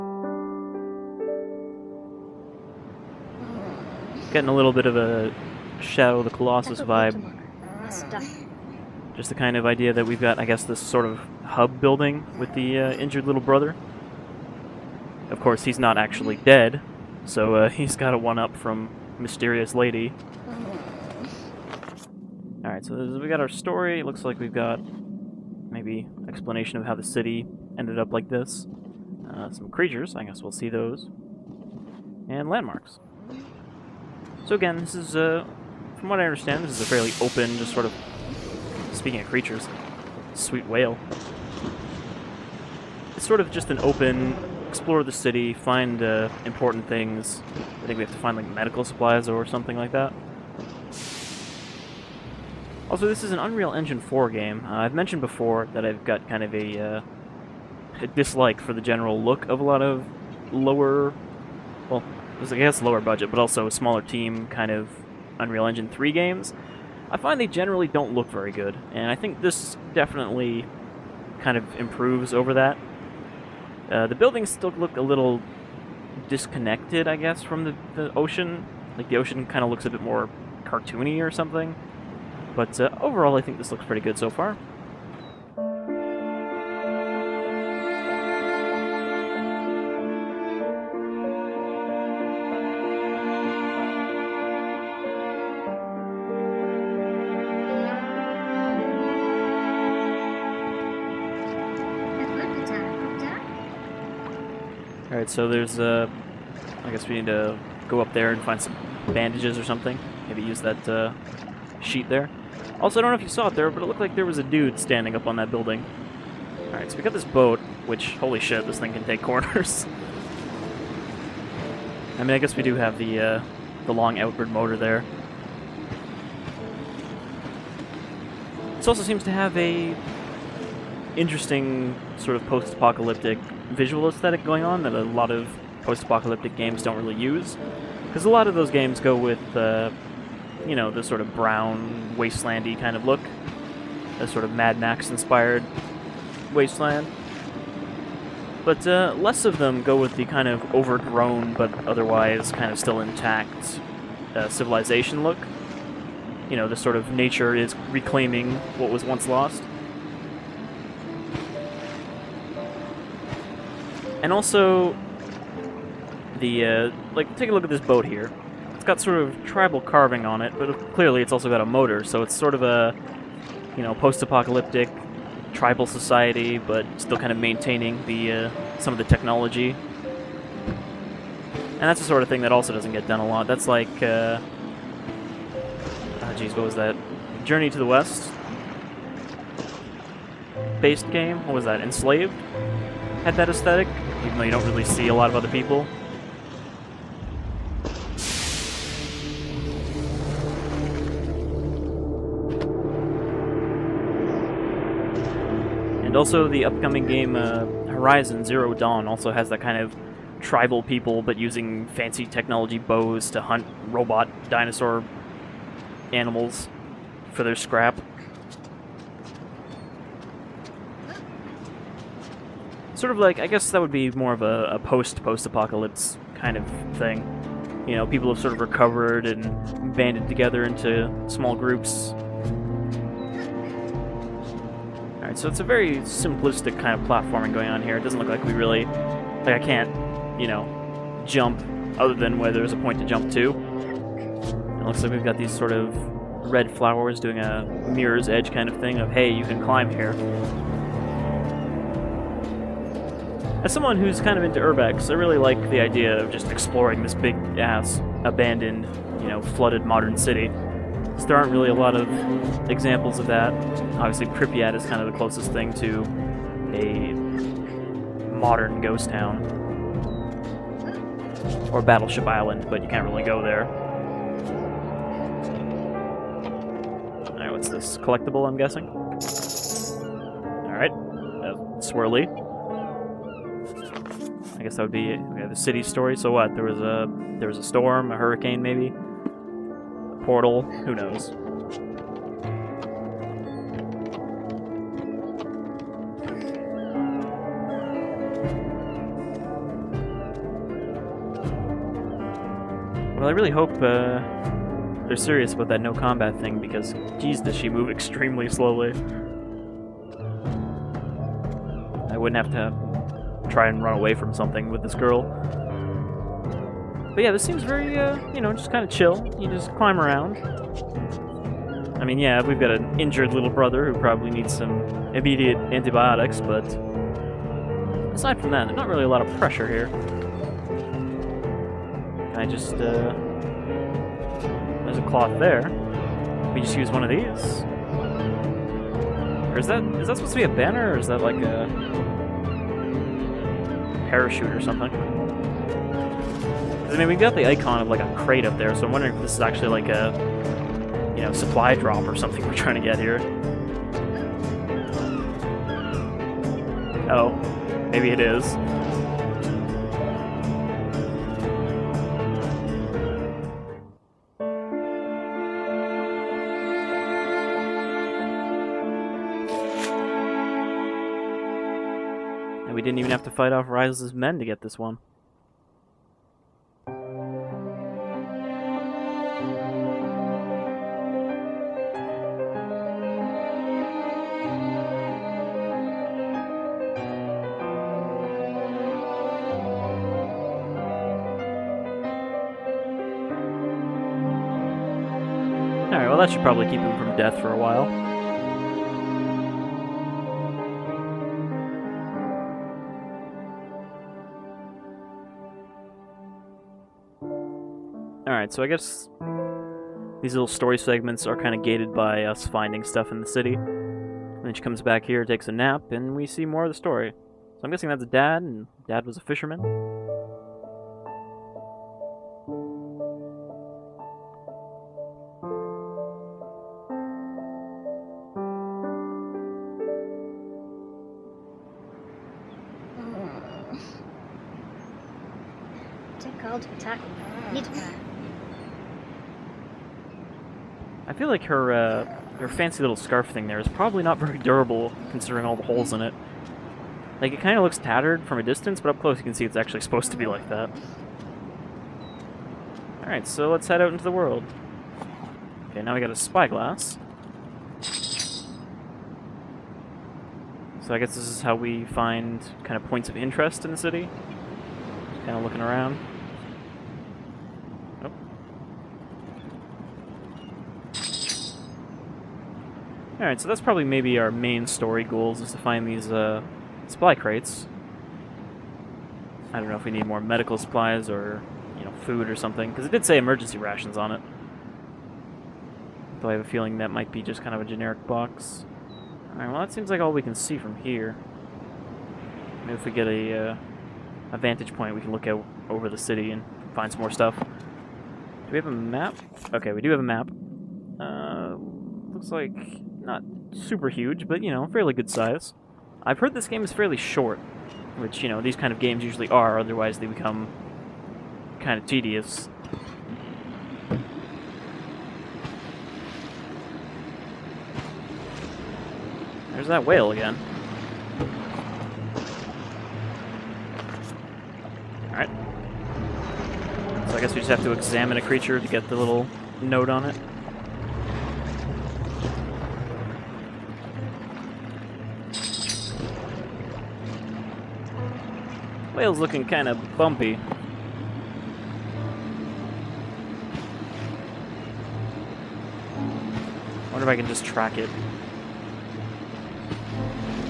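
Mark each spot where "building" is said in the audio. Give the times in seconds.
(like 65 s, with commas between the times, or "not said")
11 s, 74 s, 115 s.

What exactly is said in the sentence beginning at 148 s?
But uh, less of them go with the kind of overgrown but otherwise kind of still intact uh, civilization look.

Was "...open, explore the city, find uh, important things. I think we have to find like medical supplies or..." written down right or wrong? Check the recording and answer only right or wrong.
right.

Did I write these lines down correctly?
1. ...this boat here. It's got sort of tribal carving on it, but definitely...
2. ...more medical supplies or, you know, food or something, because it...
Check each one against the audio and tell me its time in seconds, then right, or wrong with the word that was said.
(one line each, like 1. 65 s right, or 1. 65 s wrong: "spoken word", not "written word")
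1. 167 s wrong: "clearly", not "definitely"
2. 480 s right.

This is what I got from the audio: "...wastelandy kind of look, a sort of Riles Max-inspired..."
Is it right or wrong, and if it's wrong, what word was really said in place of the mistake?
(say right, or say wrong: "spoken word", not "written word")
wrong: "Mad", not "Riles".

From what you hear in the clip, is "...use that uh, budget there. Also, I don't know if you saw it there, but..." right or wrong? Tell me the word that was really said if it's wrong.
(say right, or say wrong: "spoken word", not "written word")
wrong: "sheet", not "budget".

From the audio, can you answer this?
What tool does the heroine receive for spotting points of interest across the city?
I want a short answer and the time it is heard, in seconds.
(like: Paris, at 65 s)
Spyglass, at 456 s.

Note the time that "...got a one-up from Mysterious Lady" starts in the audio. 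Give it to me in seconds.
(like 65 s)
17 s.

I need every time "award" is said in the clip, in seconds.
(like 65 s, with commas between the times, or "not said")
not said.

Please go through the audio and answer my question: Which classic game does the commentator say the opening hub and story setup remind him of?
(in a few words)
Shadow of the Colossus.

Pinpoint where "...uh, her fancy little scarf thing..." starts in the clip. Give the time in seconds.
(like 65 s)
441 s.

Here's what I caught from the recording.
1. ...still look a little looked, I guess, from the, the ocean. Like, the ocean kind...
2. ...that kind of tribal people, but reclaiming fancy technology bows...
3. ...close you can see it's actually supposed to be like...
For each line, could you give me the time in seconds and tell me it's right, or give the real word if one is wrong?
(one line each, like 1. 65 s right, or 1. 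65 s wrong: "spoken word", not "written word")
1. 74 s wrong: "disconnected", not "looked"
2. 209 s wrong: "using", not "reclaiming"
3. 449 s right.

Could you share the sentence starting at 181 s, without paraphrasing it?
And that's the sort of thing that also doesn't get done a lot.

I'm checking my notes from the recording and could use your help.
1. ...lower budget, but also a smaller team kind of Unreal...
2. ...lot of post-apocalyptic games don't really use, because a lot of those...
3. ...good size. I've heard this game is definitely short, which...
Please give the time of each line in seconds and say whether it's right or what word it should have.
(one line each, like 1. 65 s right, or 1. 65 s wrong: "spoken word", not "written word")
1. 62 s right
2. 135 s right
3. 504 s wrong: "fairly", not "definitely".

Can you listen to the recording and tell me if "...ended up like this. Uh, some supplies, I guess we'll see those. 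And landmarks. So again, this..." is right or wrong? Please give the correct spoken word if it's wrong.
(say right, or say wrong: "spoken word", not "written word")
wrong: "creatures", not "supplies".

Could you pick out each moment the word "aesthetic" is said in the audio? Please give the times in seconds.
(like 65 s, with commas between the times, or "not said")
134 s, 193 s.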